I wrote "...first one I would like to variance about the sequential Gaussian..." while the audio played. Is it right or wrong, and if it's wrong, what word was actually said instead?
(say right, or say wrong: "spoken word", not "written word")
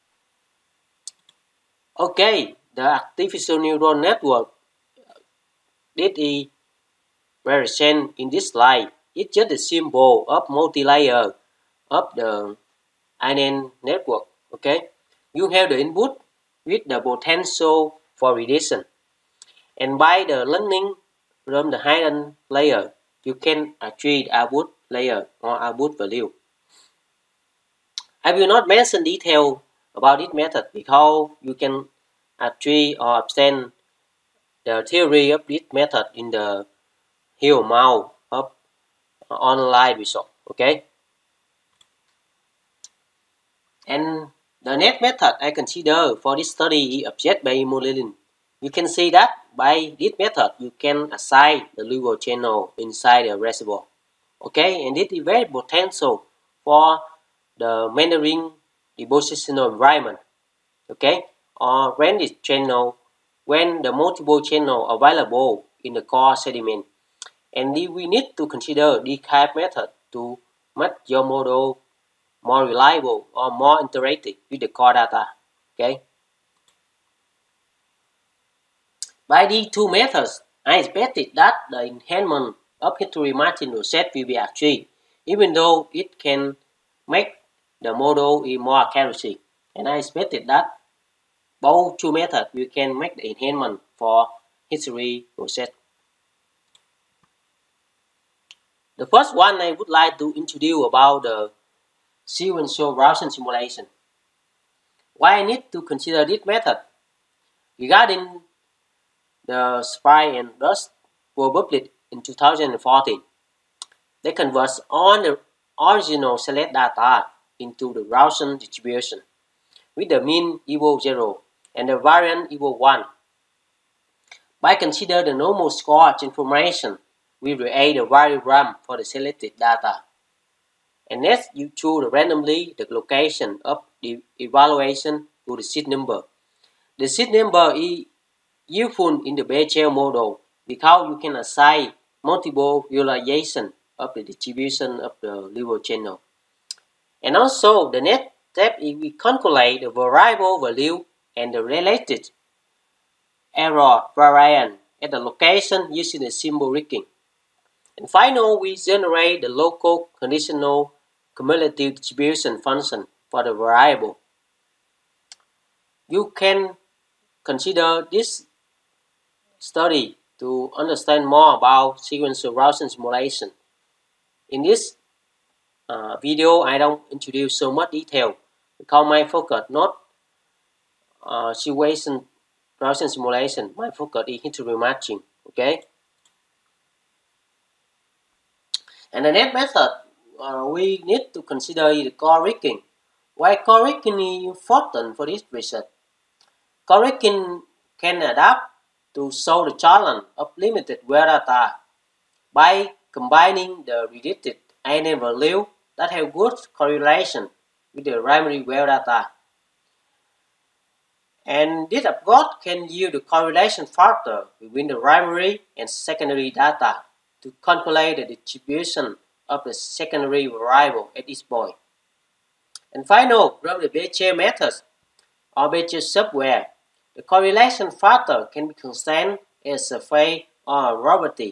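wrong: "introduce", not "variance".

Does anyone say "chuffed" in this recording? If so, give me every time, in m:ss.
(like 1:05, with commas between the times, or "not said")
not said.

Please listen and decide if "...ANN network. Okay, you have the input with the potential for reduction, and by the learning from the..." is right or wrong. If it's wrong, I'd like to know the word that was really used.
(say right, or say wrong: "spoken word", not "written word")
right.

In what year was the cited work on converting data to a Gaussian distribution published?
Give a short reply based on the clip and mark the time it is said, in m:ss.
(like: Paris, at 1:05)
2014, at 1:52.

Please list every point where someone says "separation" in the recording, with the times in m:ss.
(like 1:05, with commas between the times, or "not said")
not said.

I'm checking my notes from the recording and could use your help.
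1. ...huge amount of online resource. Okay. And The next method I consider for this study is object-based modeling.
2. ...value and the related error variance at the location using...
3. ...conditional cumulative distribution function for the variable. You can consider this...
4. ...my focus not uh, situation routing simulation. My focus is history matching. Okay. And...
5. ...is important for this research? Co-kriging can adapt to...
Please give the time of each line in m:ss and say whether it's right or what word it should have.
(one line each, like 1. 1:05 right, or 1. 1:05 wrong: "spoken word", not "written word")
1. 0:37 right
2. 2:30 right
3. 2:40 right
4. 2:59 right
5. 3:14 right.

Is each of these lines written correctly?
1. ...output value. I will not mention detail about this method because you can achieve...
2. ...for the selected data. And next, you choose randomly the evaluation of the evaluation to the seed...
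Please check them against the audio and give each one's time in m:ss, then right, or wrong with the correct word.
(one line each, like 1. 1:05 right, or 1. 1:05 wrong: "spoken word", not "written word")
1. 0:25 right
2. 2:08 wrong: "location", not "evaluation".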